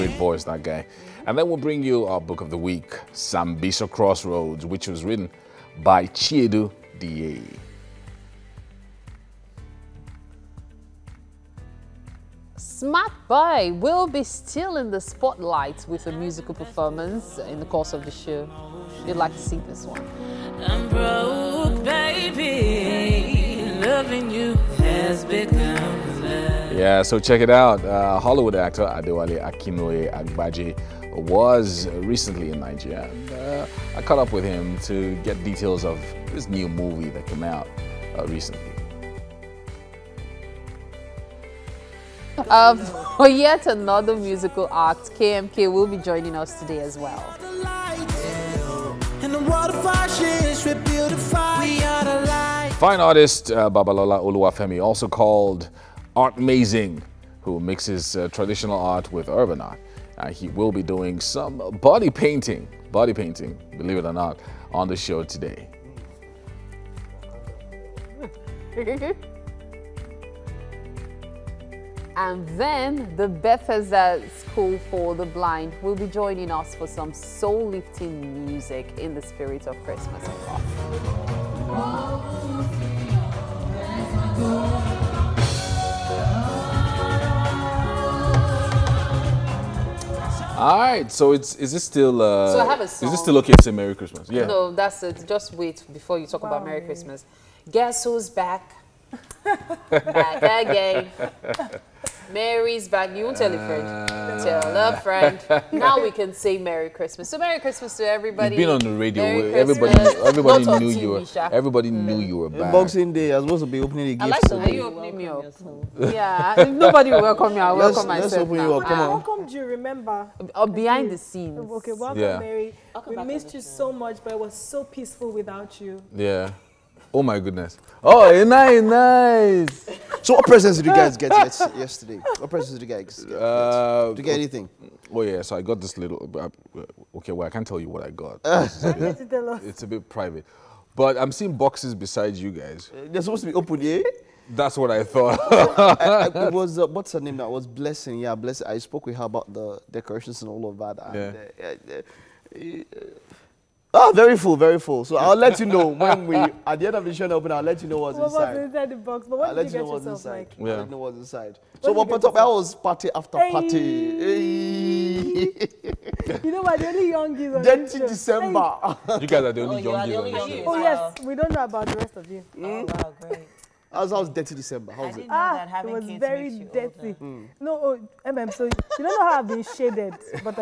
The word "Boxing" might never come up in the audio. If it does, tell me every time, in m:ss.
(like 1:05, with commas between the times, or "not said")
1:52.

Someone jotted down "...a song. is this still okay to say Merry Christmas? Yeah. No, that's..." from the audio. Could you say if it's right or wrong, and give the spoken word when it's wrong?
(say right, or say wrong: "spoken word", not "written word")
right.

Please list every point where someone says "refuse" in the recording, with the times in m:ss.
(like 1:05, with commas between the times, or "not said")
not said.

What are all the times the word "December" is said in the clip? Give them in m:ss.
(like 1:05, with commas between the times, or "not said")
2:48, 2:54.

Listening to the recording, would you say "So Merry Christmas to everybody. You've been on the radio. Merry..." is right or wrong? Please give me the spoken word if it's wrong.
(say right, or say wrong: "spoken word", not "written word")
right.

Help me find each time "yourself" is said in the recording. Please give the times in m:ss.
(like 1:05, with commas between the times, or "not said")
1:55, 2:39.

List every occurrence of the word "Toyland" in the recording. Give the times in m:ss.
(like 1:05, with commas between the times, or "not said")
not said.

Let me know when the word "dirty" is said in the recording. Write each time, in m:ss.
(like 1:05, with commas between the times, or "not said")
2:56.